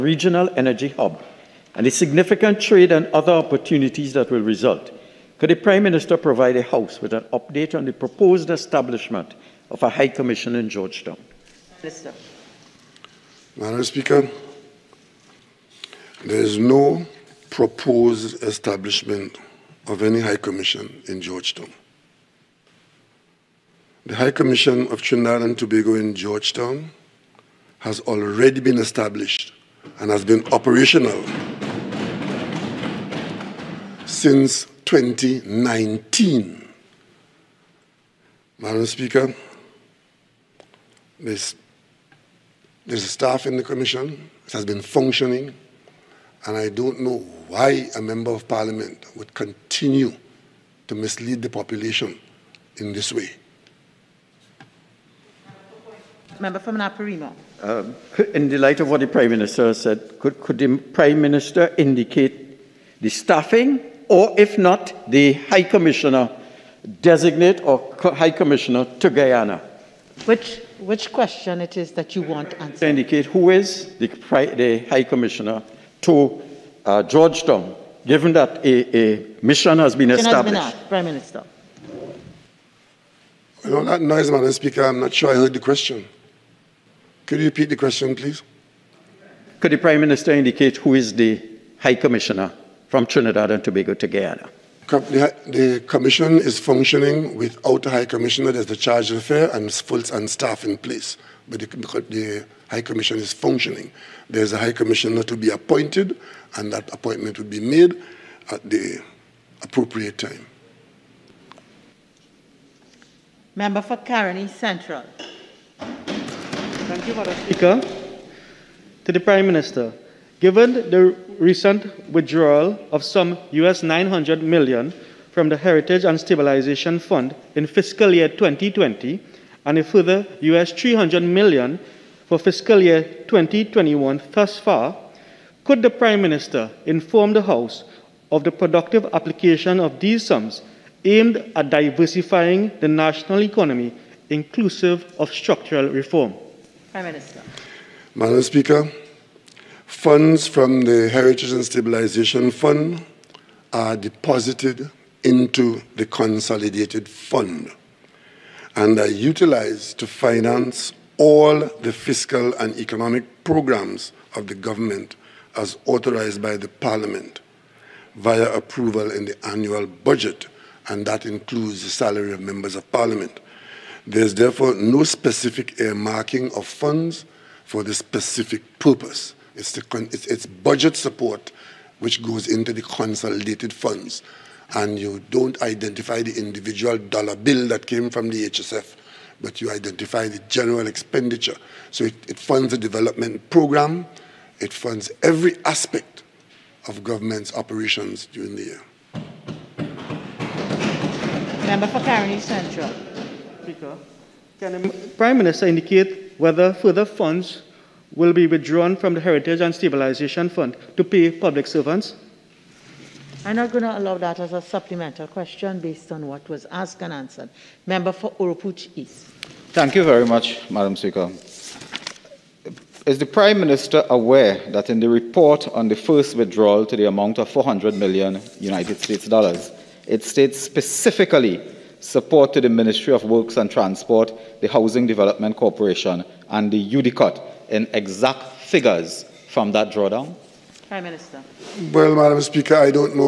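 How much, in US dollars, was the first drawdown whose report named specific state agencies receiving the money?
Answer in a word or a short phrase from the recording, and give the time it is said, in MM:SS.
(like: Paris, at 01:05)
US$400 million, at 03:47.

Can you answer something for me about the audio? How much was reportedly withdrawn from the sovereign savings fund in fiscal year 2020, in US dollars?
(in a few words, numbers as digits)
US$900 million.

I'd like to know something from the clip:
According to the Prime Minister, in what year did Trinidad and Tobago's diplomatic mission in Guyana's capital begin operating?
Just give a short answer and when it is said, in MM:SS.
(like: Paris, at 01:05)
2019, at 00:34.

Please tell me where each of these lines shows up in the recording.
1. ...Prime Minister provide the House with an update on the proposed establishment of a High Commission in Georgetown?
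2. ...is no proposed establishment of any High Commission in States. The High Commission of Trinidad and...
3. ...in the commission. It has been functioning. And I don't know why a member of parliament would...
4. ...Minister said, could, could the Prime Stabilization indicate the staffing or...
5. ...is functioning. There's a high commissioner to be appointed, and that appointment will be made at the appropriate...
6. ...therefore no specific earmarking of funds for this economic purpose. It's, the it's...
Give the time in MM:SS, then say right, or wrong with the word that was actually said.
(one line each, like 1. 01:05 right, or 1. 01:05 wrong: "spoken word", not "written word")
1. 00:05 right
2. 00:16 wrong: "Georgetown", not "States"
3. 00:43 right
4. 00:59 wrong: "Minister", not "Stabilization"
5. 01:43 right
6. 02:54 wrong: "specific", not "economic".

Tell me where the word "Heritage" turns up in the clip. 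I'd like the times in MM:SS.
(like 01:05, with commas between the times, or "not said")
02:05, 02:31, 03:29.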